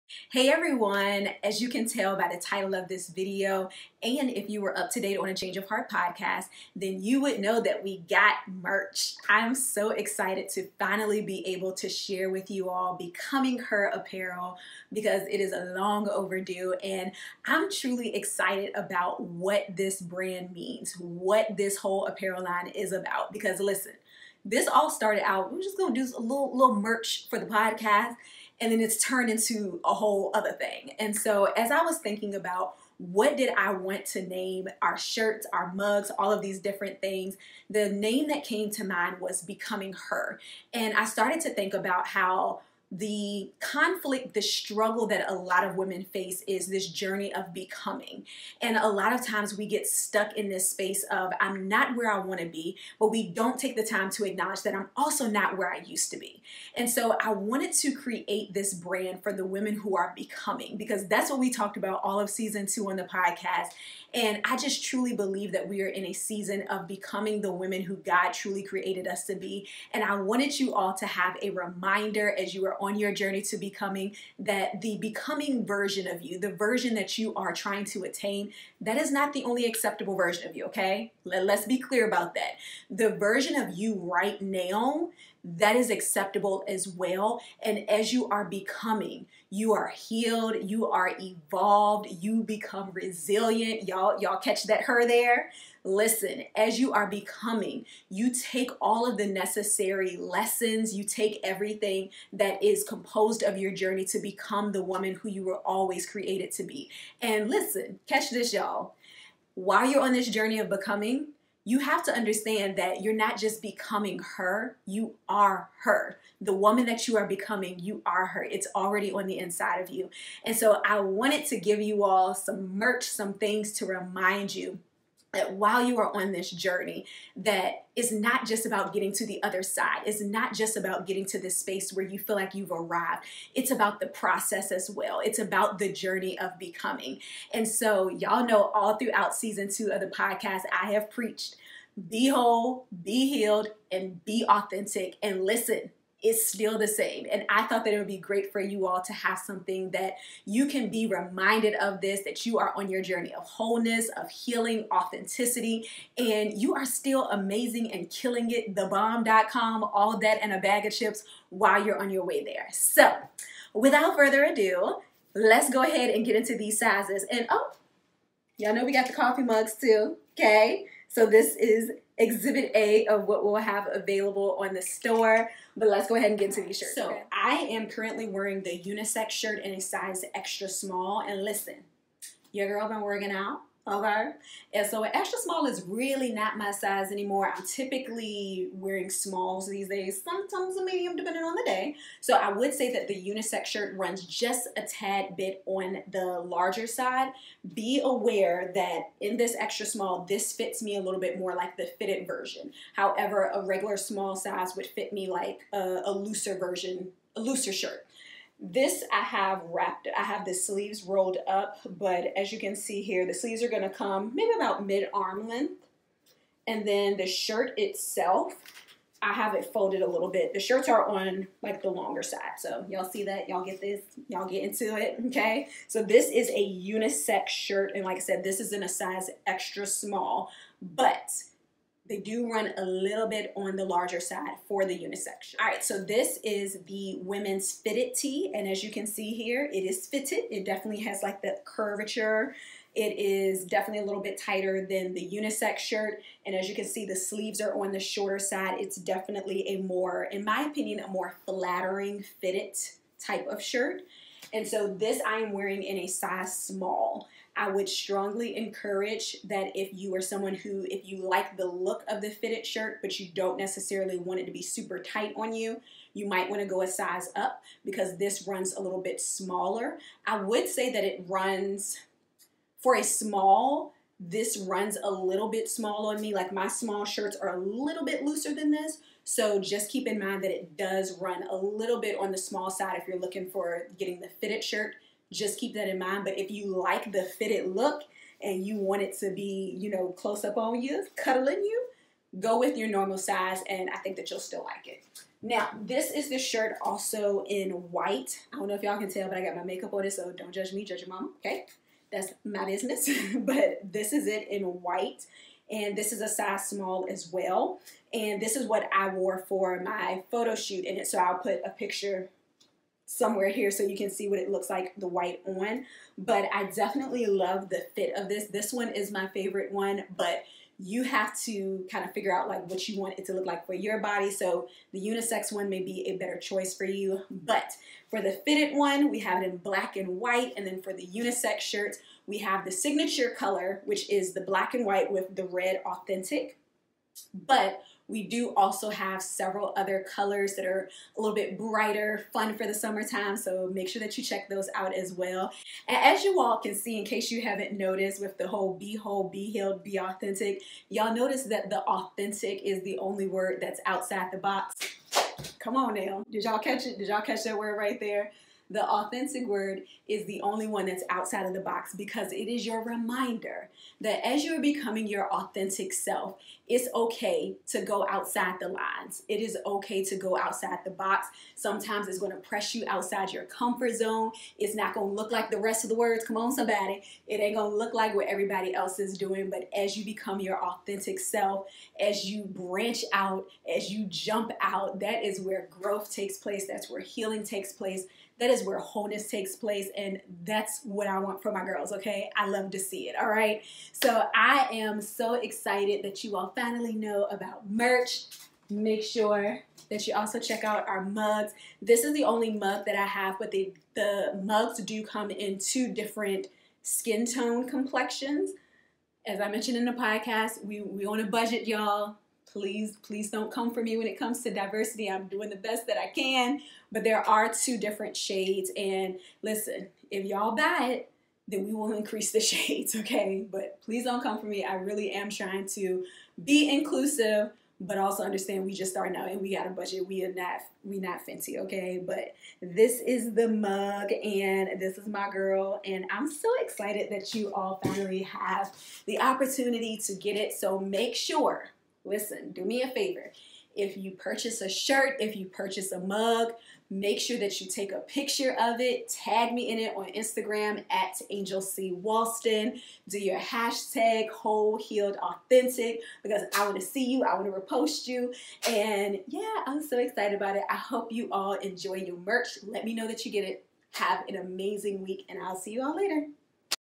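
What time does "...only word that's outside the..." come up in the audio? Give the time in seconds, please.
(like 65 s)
352 s.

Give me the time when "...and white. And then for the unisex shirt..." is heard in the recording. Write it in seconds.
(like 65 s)
329 s.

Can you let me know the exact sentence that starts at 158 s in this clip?
Thebomb.com, all that and a bag of chips while you're on your way there.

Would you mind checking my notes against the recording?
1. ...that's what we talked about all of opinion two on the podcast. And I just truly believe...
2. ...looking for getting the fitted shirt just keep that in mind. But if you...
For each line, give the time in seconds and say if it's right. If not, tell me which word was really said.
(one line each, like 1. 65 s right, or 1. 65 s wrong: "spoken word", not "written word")
1. 61 s wrong: "season", not "opinion"
2. 283 s right.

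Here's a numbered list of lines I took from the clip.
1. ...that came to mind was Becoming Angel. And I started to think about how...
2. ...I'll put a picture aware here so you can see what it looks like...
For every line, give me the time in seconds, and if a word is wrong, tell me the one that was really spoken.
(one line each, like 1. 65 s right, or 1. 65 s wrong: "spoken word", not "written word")
1. 38 s wrong: "Her", not "Angel"
2. 311 s wrong: "somewhere", not "aware".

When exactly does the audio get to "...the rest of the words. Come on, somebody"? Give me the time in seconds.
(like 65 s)
375 s.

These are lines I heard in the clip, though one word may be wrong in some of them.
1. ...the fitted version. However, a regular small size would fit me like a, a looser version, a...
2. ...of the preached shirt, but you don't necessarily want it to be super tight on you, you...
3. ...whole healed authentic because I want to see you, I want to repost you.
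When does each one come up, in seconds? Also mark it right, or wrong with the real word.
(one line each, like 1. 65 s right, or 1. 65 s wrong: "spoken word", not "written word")
1. 201 s right
2. 262 s wrong: "fitted", not "preached"
3. 454 s right.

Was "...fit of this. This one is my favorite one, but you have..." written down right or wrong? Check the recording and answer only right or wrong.
right.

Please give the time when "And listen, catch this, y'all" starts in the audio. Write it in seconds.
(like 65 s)
107 s.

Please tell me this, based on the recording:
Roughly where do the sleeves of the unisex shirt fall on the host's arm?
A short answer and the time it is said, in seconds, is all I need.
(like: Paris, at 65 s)
mid arm length, at 214 s.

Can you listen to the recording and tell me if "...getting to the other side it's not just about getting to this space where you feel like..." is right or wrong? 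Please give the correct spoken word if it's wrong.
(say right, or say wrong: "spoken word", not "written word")
right.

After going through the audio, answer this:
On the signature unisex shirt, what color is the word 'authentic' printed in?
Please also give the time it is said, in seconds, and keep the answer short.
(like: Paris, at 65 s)
red, at 335 s.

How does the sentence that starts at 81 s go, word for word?
Let, us be clear about that.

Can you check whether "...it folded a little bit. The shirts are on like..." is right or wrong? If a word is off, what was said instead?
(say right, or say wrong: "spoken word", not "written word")
right.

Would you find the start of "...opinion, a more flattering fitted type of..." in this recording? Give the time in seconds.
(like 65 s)
250 s.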